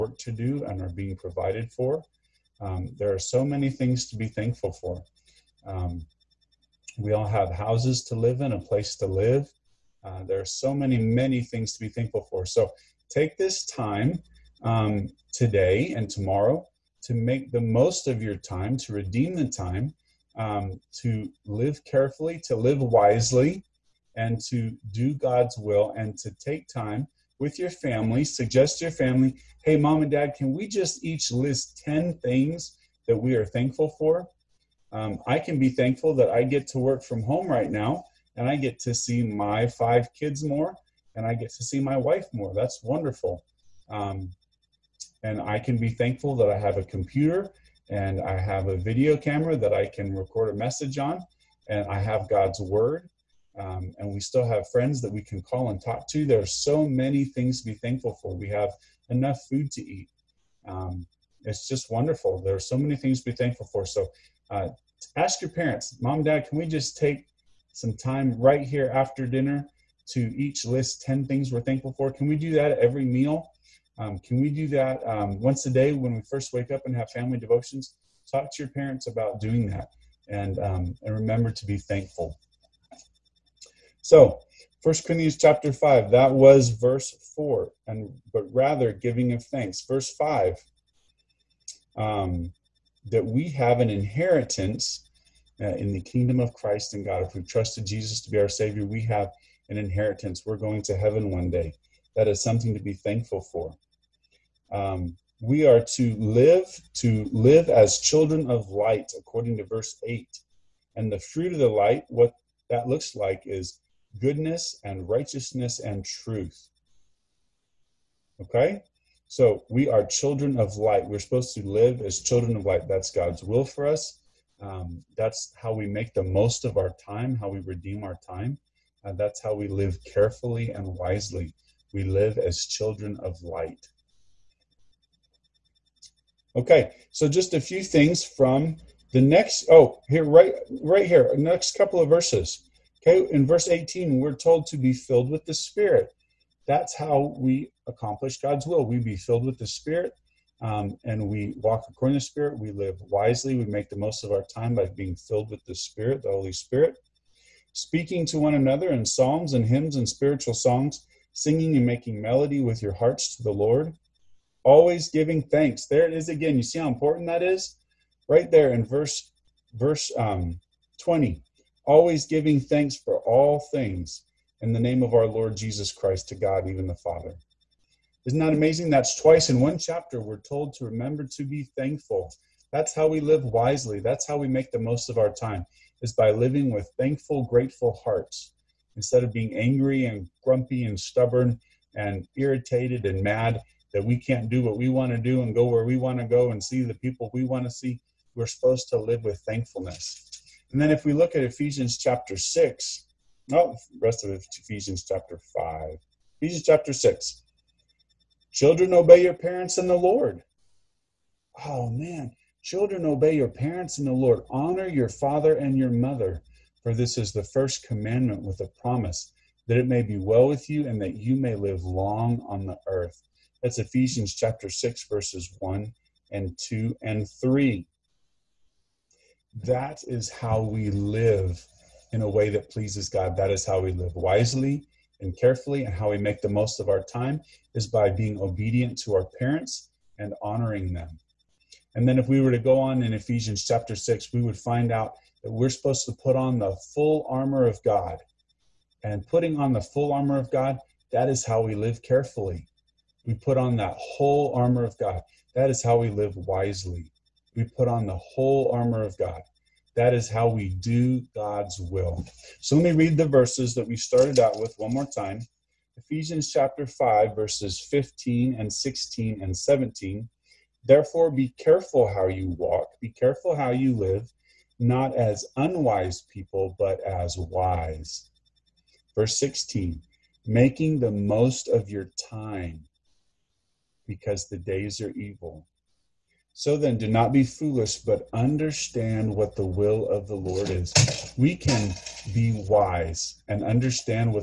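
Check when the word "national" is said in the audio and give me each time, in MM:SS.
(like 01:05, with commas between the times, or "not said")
not said.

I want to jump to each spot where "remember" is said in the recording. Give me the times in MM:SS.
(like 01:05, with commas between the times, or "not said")
01:21, 03:00.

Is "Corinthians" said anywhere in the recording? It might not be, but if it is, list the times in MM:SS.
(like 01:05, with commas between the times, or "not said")
01:25.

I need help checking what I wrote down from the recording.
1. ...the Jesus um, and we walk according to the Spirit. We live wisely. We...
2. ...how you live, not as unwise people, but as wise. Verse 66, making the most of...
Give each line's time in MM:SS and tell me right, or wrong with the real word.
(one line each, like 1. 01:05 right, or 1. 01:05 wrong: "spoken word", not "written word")
1. 02:29 wrong: "Spirit", not "Jesus"
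2. 04:33 wrong: "16", not "66".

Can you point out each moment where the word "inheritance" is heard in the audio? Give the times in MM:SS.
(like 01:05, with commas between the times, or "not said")
01:33, 01:39.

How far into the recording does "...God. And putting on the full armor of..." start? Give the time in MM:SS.
04:07.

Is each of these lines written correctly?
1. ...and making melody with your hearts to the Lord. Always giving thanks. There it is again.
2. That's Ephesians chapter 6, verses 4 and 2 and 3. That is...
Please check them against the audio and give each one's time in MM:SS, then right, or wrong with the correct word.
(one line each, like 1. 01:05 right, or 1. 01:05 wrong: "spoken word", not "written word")
1. 02:41 right
2. 03:43 wrong: "1", not "4".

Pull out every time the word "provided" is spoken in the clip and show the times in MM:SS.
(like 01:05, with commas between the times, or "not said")
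00:01.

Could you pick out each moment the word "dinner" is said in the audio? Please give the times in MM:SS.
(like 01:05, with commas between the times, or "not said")
01:09.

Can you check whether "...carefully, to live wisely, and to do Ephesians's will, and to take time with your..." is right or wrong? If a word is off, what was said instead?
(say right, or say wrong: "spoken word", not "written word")
wrong: "God", not "Ephesians".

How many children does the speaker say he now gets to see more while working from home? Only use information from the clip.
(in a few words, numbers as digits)
5.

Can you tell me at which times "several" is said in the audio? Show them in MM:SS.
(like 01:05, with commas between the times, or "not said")
not said.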